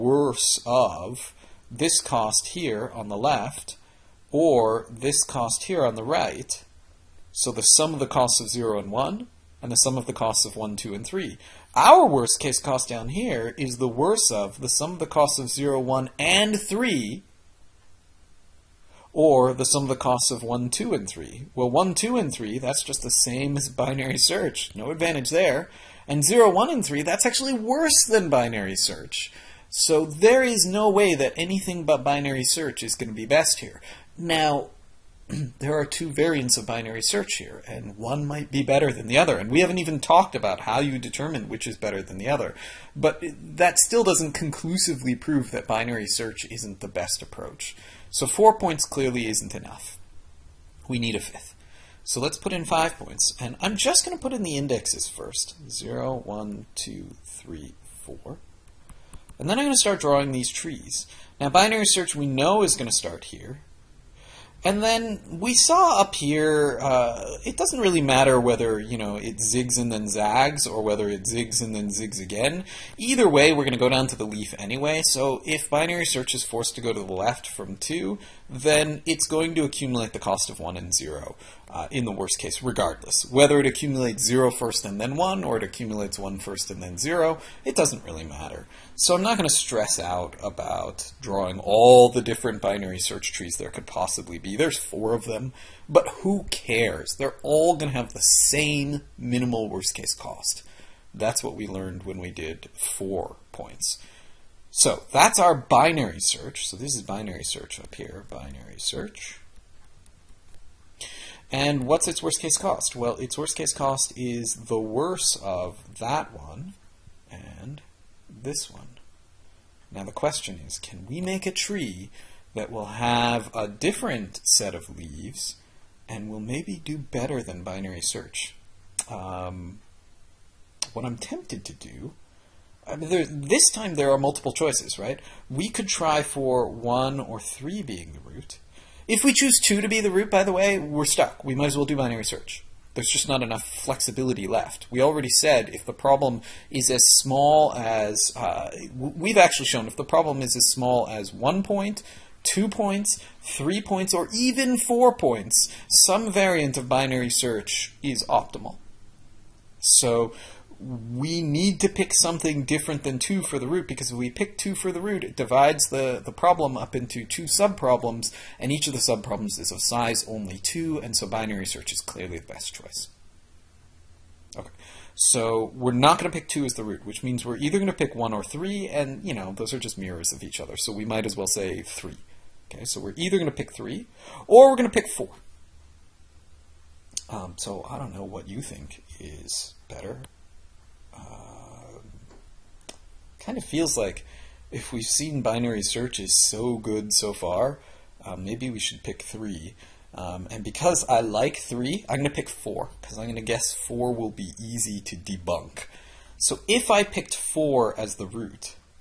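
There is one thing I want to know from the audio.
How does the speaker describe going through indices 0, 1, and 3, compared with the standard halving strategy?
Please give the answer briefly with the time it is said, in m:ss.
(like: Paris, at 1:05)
worse than binary search, at 0:27.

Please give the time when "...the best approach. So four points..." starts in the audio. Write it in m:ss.
0:46.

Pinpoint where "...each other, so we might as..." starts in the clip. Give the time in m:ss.
3:00.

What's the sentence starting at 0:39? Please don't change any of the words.
And we haven't even talked about how you determine which is better than the other.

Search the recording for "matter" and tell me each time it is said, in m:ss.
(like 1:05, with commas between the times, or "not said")
1:08, 1:28.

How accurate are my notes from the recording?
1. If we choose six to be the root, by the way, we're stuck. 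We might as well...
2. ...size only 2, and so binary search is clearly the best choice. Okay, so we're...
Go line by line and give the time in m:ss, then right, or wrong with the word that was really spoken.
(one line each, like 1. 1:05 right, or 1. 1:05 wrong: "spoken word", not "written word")
1. 2:19 wrong: "two", not "six"
2. 2:49 right.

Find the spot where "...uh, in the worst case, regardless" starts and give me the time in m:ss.
1:21.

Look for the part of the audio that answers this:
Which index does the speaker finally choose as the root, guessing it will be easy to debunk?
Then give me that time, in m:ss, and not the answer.
3:22.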